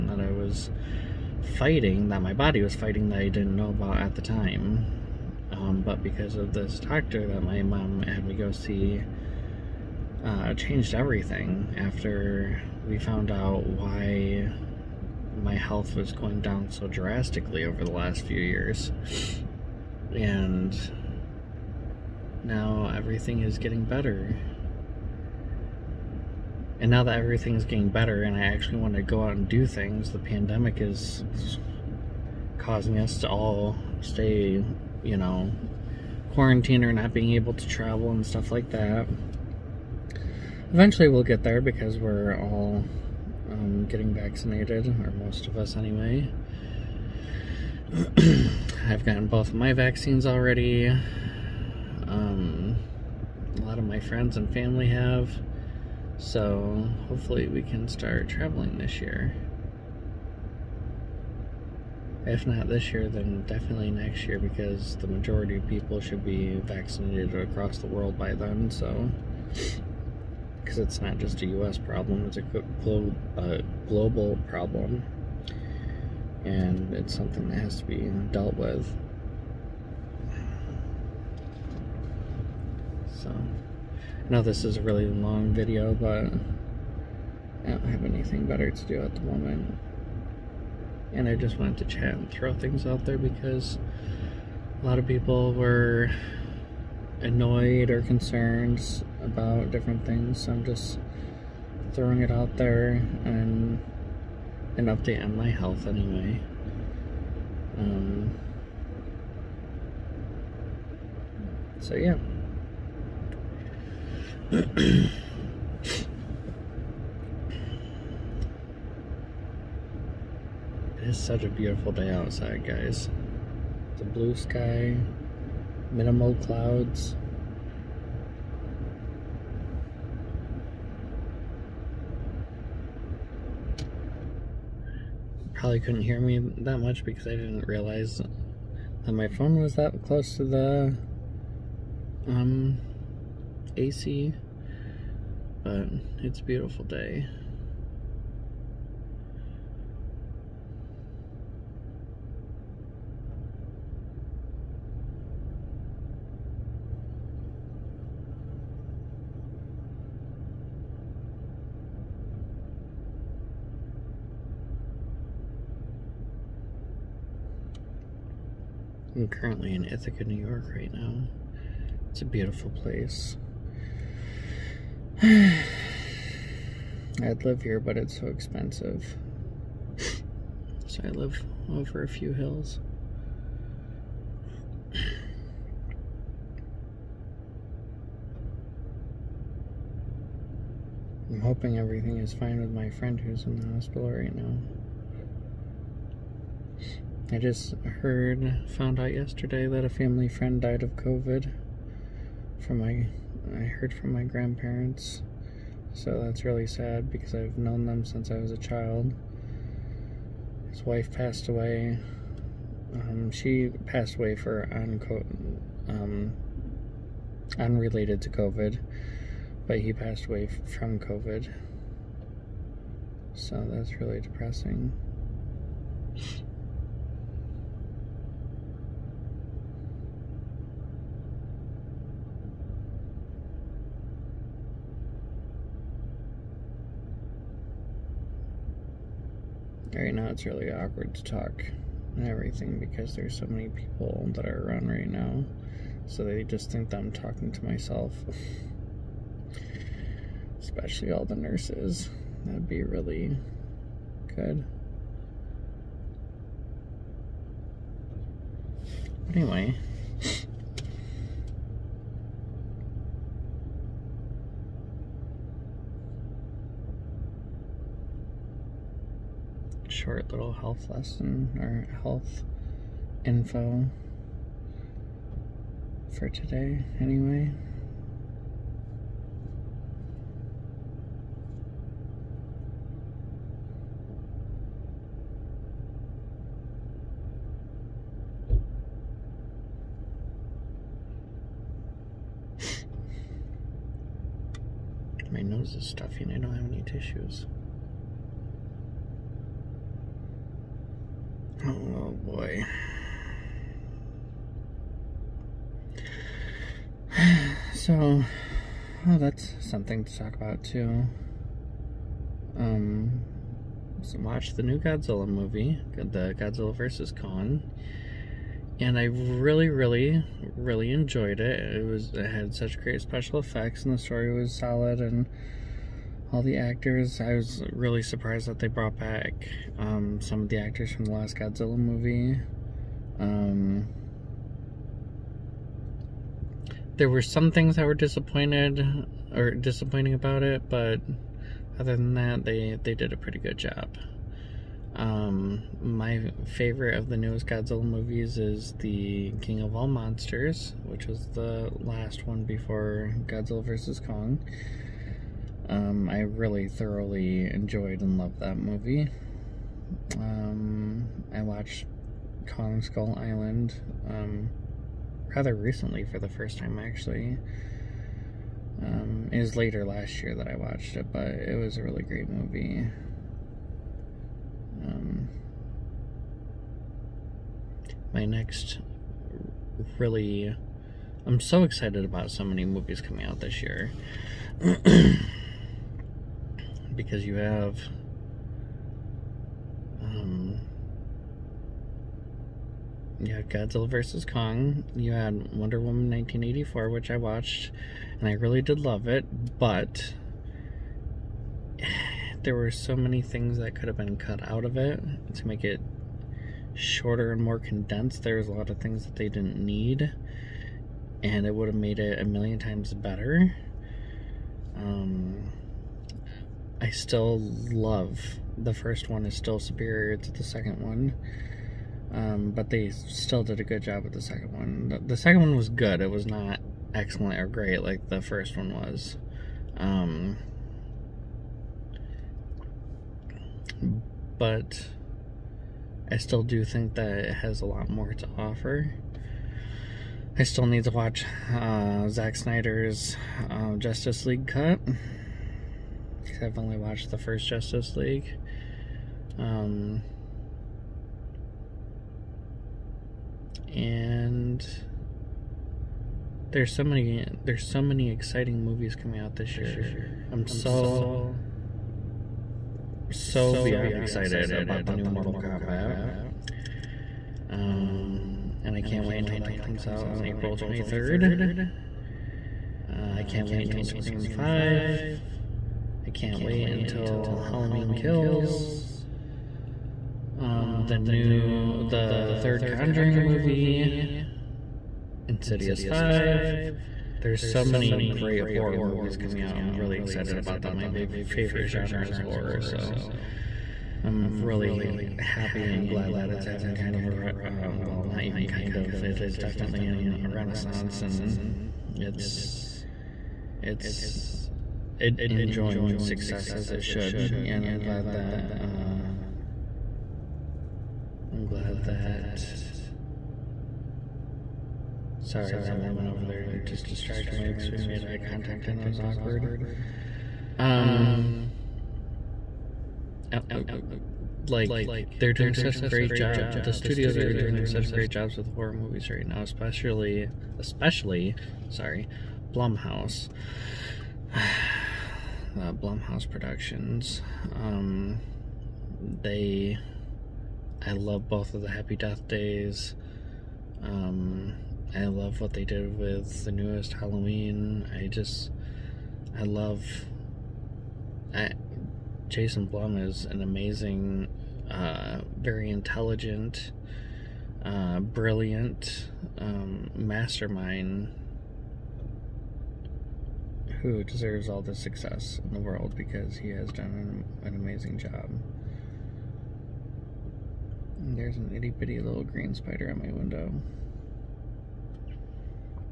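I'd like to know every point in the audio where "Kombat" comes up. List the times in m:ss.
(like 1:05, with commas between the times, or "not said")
7:45.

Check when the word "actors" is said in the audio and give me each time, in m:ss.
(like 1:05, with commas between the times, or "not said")
5:26, 5:30.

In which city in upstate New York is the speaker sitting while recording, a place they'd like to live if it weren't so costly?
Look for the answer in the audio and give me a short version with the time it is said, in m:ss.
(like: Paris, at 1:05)
Ithaca, at 2:49.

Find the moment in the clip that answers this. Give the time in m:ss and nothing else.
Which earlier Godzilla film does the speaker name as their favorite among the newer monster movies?
5:49.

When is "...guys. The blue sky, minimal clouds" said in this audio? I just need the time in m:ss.
2:02.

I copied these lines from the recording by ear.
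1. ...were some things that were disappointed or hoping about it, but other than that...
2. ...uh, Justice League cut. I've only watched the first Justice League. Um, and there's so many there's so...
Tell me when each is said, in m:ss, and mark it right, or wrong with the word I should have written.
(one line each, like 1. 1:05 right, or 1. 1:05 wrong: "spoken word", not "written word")
1. 5:37 wrong: "disappointing", not "hoping"
2. 7:23 right.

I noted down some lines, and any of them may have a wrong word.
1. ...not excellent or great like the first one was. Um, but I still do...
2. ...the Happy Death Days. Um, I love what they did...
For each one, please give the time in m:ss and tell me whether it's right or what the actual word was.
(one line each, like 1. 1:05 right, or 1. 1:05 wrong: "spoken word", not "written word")
1. 7:06 right
2. 9:01 right.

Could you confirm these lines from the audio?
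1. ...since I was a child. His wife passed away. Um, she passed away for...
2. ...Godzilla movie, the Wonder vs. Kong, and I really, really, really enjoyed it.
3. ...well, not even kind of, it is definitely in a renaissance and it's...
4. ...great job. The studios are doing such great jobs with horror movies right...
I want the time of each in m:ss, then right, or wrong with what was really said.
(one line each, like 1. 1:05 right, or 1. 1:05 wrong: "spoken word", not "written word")
1. 3:28 right
2. 5:14 wrong: "Godzilla", not "Wonder"
3. 8:17 right
4. 8:45 right.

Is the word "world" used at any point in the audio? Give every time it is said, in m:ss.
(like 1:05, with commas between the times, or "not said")
1:07, 9:25.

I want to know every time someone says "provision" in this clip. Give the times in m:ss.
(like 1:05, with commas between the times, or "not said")
not said.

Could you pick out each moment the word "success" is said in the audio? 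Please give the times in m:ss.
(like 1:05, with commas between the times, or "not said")
8:25, 9:24.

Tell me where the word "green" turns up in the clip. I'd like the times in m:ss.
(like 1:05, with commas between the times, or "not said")
9:32.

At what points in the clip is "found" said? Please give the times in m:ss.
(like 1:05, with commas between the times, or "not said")
0:12, 3:18.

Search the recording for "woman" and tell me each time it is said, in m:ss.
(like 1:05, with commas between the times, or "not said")
6:35, 8:35.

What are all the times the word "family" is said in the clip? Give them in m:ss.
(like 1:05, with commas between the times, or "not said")
0:54, 3:19.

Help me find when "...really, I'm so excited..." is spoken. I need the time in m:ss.
6:19.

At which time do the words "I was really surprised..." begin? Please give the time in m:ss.
5:27.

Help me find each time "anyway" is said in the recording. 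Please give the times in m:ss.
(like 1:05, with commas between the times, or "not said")
0:45, 1:45, 4:19, 4:37.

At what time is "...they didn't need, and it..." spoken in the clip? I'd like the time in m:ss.
6:49.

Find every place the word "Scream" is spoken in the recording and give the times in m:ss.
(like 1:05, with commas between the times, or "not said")
7:53.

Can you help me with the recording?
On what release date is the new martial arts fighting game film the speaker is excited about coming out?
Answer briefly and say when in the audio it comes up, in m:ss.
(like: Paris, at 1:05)
April 23rd, at 7:50.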